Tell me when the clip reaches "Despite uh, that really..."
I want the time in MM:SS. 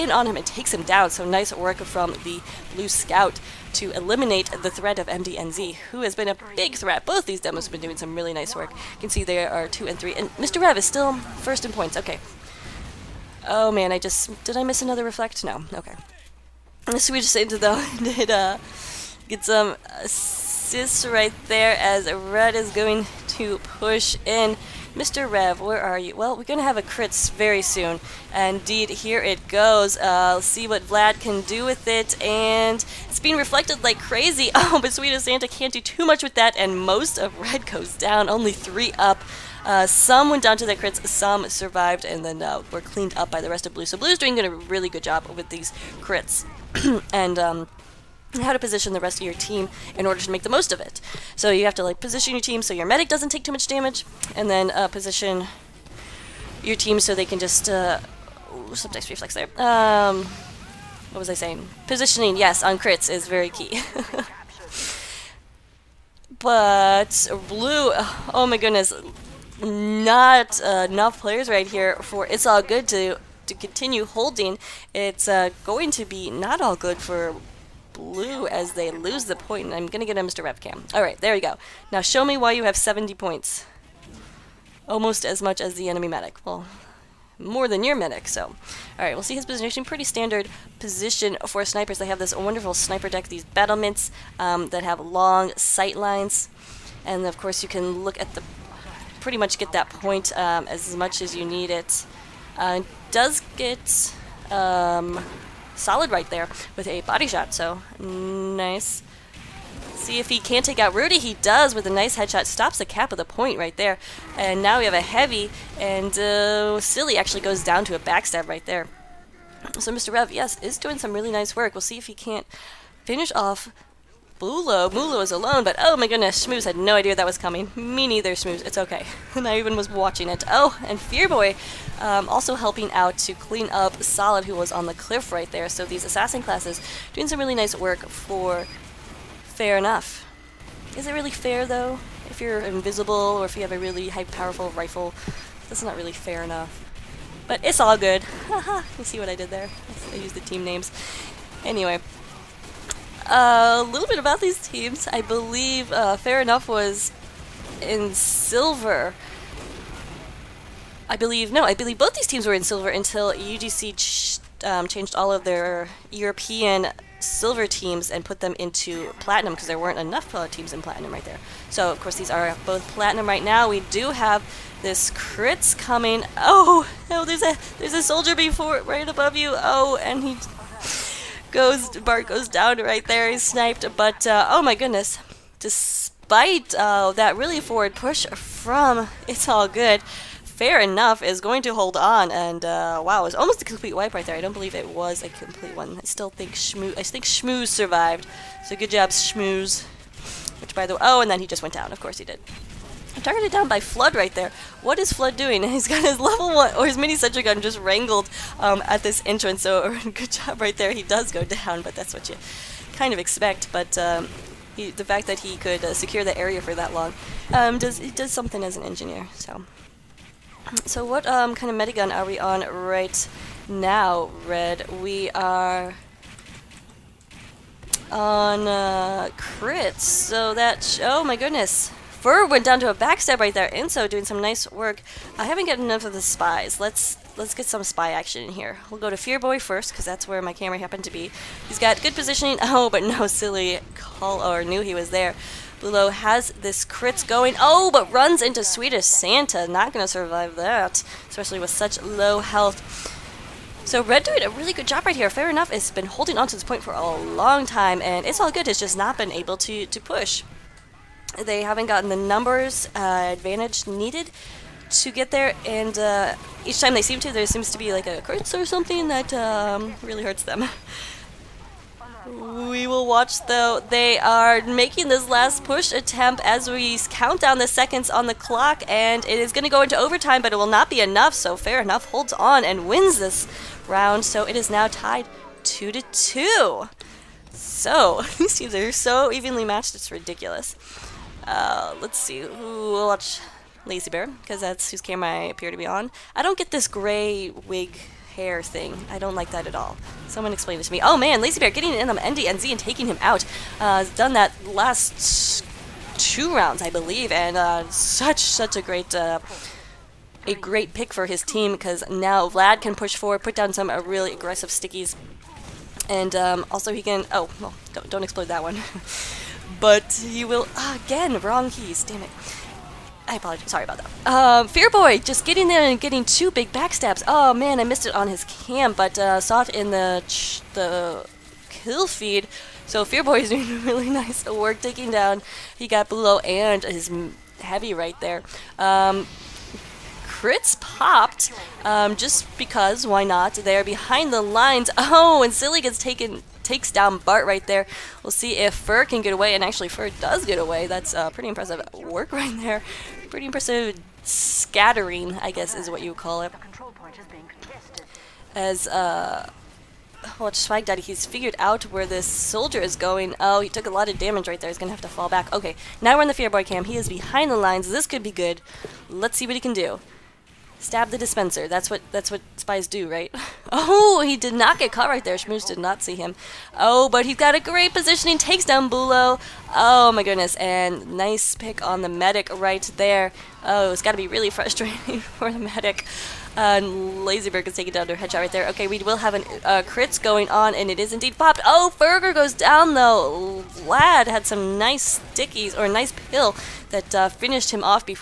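03:05.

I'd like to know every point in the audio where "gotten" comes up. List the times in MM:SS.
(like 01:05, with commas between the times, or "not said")
03:55, 04:21.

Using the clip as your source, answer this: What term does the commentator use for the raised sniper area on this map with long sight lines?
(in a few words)
battlements.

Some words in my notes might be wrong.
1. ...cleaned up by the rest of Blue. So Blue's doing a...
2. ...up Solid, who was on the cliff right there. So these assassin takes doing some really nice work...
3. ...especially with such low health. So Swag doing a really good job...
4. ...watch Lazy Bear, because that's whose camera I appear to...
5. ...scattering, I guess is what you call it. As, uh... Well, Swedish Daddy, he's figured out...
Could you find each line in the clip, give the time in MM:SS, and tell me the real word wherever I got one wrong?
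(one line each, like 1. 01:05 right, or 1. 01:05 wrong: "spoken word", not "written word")
1. 00:42 right
2. 02:13 wrong: "classes", not "takes"
3. 04:11 wrong: "Red", not "Swag"
4. 04:53 right
5. 05:54 wrong: "Swag", not "Swedish".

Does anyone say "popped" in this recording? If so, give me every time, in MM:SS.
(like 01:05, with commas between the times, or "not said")
05:40, 06:31.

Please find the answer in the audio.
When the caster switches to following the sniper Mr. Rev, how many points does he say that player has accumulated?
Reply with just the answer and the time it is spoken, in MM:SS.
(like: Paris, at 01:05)
70, at 01:22.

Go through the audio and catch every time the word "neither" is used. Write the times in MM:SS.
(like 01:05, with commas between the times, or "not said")
02:08.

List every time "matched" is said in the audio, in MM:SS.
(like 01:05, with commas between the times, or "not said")
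04:49.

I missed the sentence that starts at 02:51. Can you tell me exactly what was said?
So, of course, these are both platinum right now.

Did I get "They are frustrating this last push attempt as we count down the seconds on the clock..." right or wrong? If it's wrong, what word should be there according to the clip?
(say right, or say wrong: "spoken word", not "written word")
wrong: "making", not "frustrating".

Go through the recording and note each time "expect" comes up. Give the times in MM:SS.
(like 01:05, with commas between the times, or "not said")
03:33.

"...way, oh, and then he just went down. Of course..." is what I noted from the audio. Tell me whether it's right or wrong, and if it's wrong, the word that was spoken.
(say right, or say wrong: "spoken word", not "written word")
right.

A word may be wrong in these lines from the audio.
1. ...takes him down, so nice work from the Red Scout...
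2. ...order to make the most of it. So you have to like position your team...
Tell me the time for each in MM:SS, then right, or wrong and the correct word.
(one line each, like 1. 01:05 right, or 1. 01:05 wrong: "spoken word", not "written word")
1. 00:00 wrong: "Blue", not "Red"
2. 00:50 right.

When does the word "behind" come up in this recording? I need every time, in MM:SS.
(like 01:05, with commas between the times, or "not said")
05:43, 06:07.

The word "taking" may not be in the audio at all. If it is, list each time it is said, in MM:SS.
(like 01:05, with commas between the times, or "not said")
05:02, 05:34.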